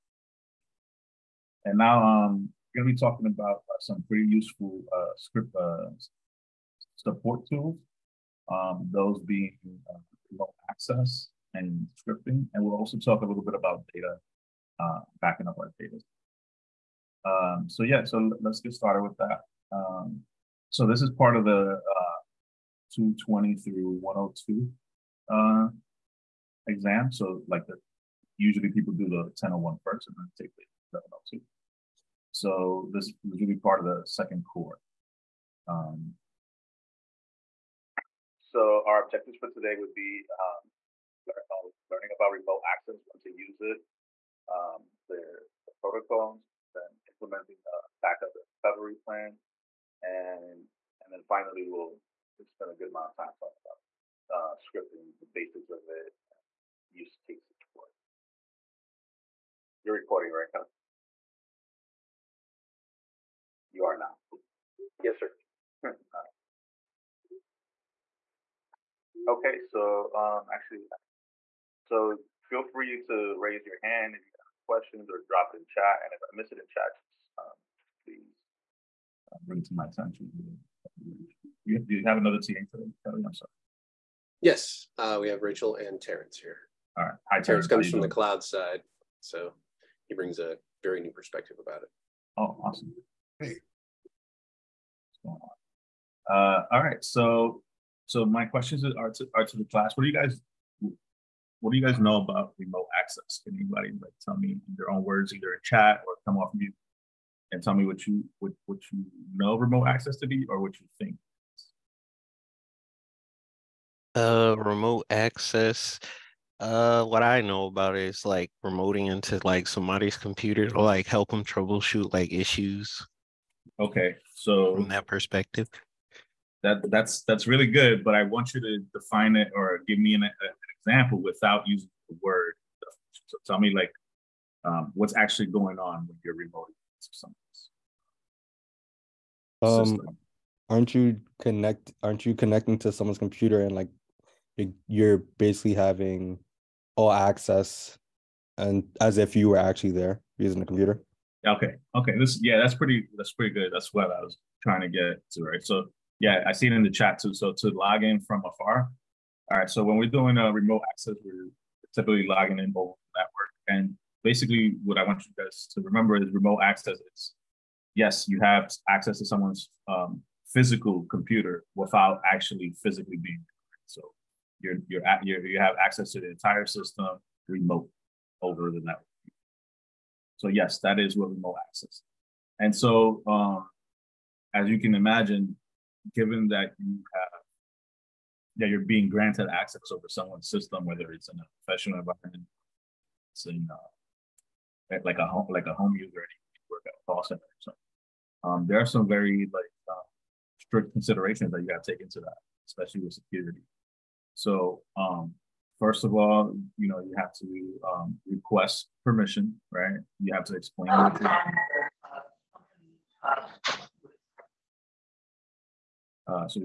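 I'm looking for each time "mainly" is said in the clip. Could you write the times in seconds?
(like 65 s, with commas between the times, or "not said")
not said.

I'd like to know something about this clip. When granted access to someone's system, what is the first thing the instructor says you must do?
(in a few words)
Request permission.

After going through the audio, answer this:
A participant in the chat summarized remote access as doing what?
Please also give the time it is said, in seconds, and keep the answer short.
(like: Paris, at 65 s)
Log in from afar, at 157 s.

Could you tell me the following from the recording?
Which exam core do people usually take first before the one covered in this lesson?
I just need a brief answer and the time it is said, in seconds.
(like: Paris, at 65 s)
1001, at 29 s.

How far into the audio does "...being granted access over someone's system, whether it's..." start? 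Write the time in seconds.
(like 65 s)
188 s.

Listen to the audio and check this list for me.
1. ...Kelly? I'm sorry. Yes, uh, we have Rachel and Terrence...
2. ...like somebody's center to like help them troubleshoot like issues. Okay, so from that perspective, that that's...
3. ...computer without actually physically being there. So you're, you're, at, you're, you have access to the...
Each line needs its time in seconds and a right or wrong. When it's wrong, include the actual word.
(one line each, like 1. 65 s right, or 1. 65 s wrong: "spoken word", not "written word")
1. 83 s right
2. 119 s wrong: "computer", not "center"
3. 171 s right.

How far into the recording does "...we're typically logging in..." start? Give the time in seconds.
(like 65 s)
161 s.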